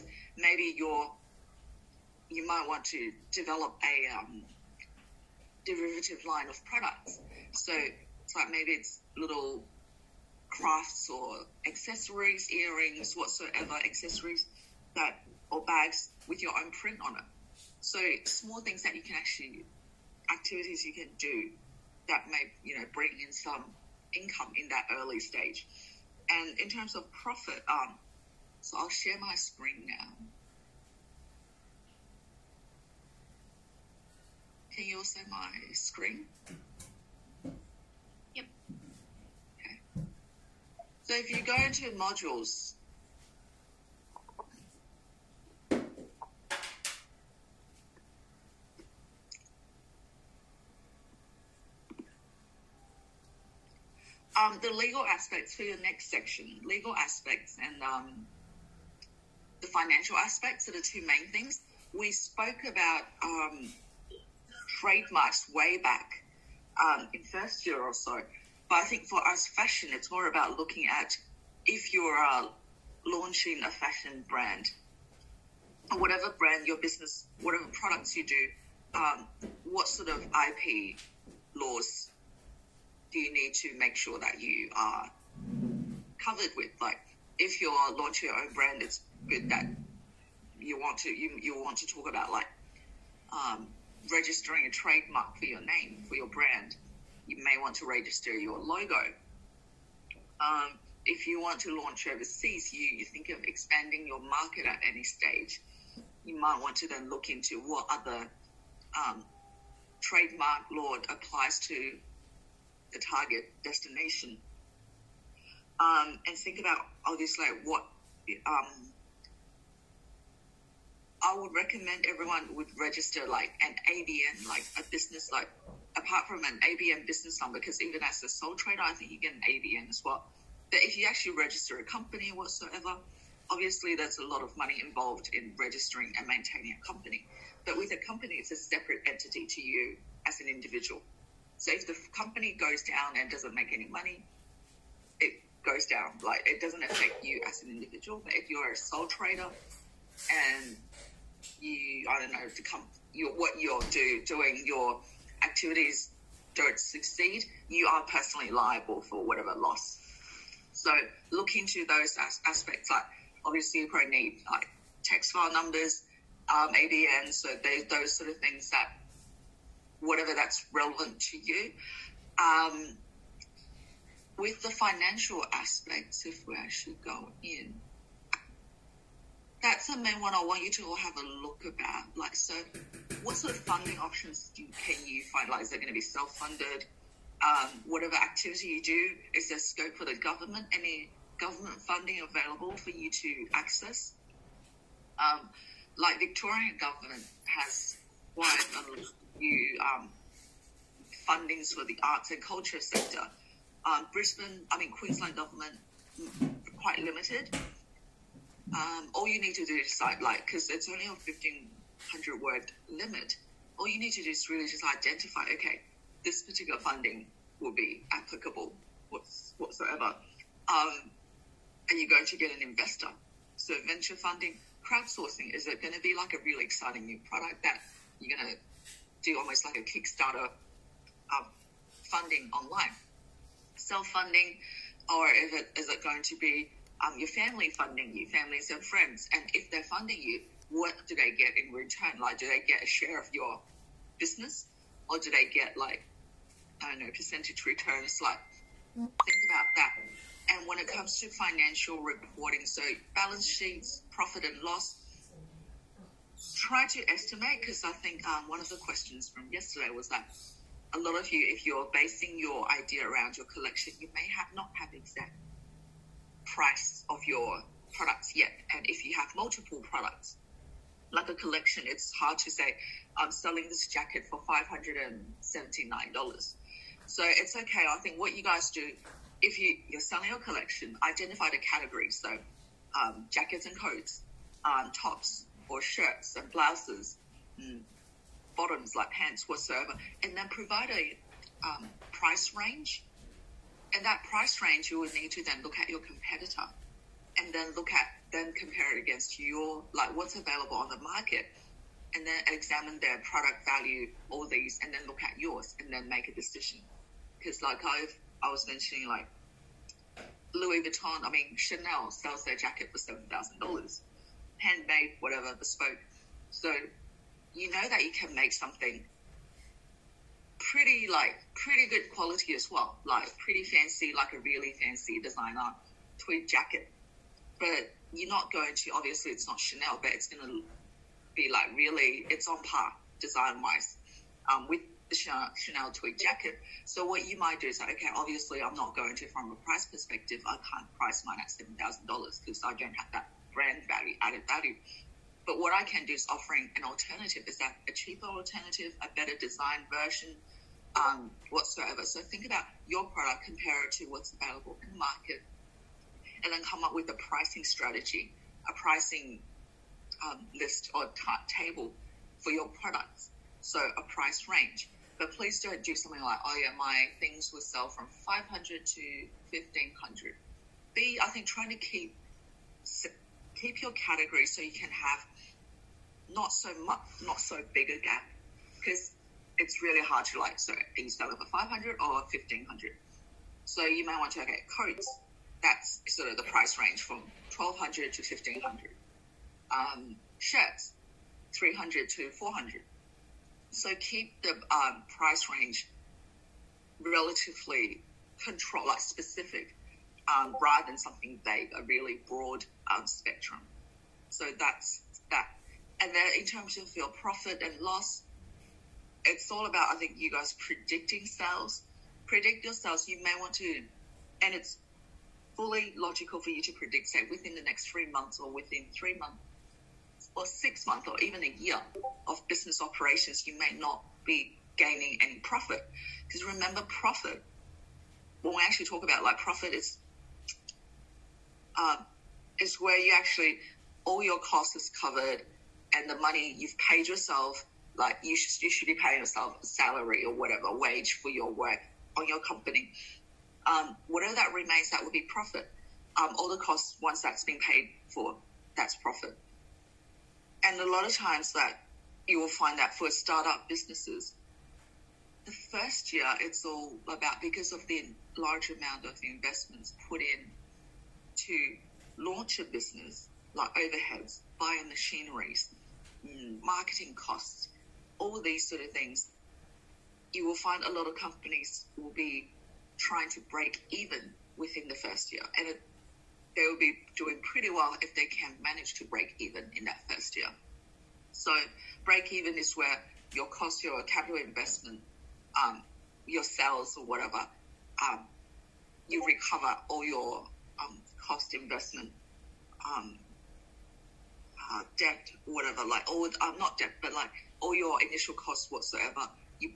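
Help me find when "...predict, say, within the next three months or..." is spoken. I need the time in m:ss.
6:56.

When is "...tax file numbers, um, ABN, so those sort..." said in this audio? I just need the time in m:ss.
2:45.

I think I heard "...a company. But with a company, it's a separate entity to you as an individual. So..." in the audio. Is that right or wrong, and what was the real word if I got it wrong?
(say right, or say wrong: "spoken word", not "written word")
right.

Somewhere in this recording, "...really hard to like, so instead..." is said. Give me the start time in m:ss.
6:19.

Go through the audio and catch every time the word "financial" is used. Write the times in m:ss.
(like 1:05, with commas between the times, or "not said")
0:59, 2:54, 4:11.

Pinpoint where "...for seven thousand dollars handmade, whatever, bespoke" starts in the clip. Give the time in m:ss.
5:12.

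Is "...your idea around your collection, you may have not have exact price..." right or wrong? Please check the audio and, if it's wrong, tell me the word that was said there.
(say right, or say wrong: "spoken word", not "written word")
right.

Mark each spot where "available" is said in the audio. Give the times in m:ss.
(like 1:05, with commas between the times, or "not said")
3:12, 5:00, 5:54.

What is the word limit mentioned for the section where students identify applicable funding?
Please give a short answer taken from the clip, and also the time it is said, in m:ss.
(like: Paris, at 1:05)
1500, at 3:31.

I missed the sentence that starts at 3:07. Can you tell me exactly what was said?
Um, whatever activity you do, is there scope for the government?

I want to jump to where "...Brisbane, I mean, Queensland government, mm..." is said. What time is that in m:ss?
3:24.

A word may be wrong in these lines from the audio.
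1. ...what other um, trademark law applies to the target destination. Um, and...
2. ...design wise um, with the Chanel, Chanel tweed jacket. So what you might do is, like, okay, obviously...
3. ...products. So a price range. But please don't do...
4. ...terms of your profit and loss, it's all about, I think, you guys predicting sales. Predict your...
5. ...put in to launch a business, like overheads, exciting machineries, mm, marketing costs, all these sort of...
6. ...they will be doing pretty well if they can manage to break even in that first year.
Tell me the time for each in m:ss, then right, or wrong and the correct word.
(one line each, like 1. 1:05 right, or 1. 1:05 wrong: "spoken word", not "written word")
1. 1:47 right
2. 5:33 right
3. 6:02 right
4. 6:46 right
5. 7:40 wrong: "buying", not "exciting"
6. 7:56 right.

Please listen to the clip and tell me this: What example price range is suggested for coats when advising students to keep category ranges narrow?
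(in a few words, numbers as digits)
1200 to 1500.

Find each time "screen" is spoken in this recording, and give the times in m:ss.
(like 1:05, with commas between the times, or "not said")
0:29, 0:35.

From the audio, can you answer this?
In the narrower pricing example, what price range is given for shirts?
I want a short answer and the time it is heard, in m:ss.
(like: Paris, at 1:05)
300 to 400, at 6:31.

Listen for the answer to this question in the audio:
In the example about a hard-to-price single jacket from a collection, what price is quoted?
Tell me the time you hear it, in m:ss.
4:34.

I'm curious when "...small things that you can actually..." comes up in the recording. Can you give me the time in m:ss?
0:18.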